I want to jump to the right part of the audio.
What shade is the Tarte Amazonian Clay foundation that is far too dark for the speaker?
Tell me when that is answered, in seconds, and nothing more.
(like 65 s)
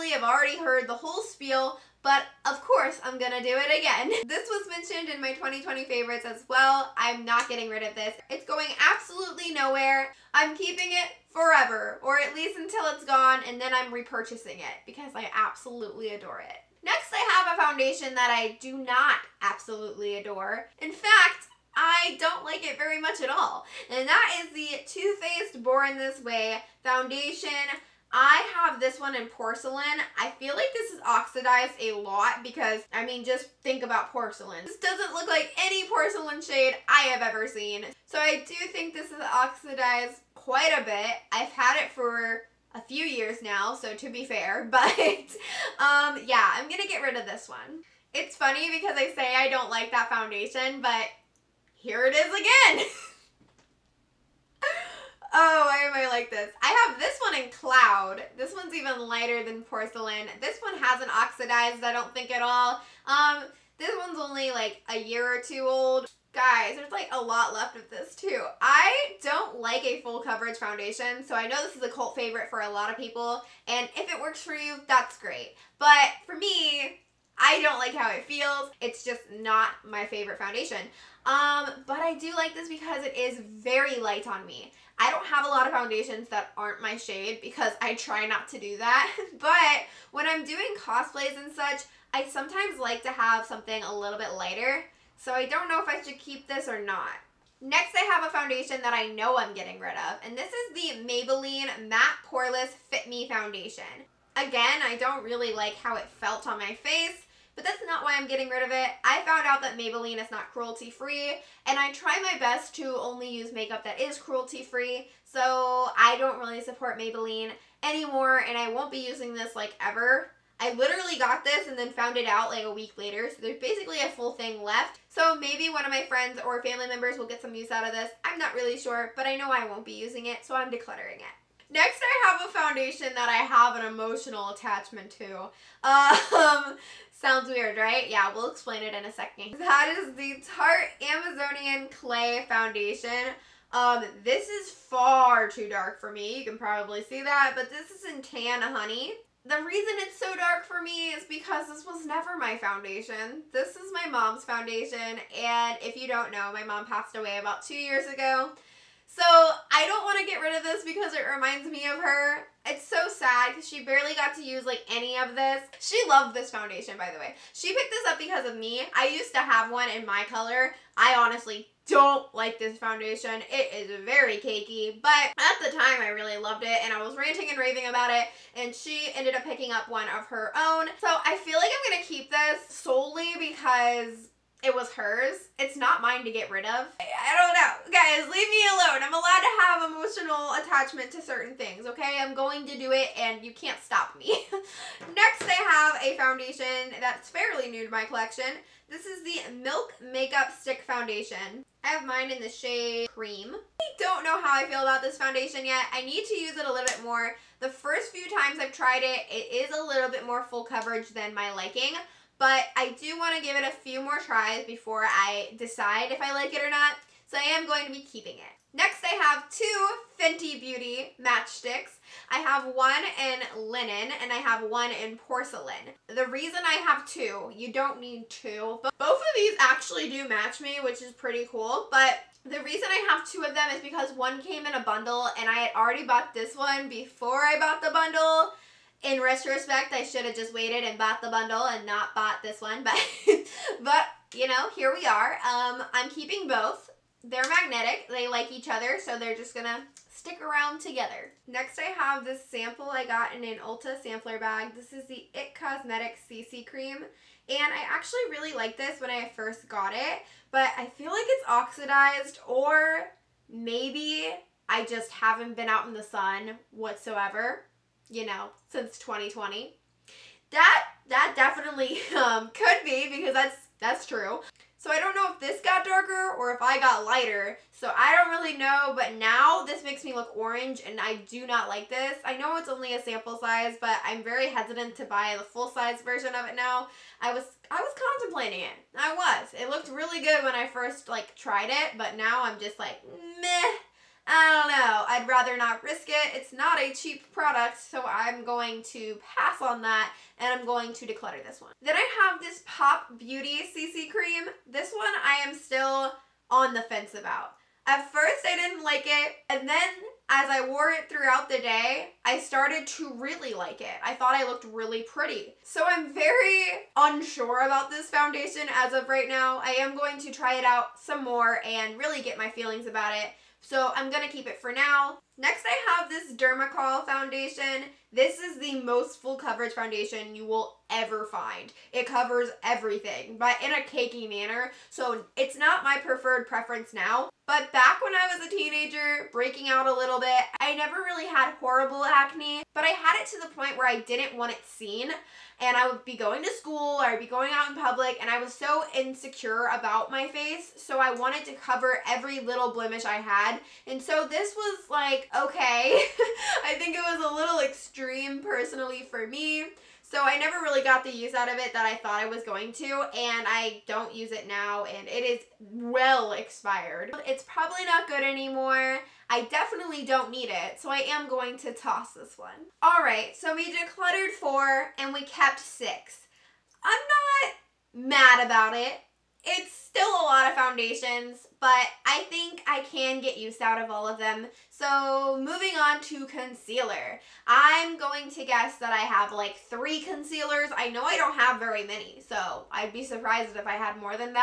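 148 s.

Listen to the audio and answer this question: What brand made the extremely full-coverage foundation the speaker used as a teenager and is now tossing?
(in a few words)
Dermacol.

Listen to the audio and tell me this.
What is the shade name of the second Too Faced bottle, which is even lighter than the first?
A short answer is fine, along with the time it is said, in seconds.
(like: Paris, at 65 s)
Cloud, at 57 s.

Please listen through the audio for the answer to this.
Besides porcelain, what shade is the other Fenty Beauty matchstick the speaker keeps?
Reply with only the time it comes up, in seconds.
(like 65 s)
223 s.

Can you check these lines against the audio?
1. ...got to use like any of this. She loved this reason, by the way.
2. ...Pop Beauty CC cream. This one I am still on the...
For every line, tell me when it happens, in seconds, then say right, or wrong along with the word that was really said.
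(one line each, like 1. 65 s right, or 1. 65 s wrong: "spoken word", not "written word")
1. 164 s wrong: "foundation", not "reason"
2. 302 s right.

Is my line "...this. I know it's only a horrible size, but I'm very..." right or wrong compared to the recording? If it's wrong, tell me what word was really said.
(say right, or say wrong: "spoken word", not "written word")
wrong: "sample", not "horrible".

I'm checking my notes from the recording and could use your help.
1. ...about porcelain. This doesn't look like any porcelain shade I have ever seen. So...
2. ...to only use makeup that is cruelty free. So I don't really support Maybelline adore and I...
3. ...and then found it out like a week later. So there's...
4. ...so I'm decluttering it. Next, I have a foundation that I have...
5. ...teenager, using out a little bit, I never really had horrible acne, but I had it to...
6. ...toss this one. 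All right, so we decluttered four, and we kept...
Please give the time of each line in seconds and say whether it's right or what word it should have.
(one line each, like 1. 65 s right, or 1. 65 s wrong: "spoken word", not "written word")
1. 33 s right
2. 112 s wrong: "anymore", not "adore"
3. 121 s right
4. 130 s right
5. 338 s wrong: "breaking", not "using"
6. 371 s right.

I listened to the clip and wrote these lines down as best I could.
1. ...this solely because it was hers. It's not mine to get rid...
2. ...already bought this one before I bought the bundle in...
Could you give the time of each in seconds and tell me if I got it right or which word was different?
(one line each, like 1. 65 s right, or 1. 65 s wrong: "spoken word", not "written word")
1. 182 s right
2. 235 s right.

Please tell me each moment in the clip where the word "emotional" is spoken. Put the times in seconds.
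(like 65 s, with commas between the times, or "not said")
133 s, 189 s.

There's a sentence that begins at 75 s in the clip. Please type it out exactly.
But for me, I don't like how it feels.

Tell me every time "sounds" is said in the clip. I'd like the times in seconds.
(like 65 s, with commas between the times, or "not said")
137 s.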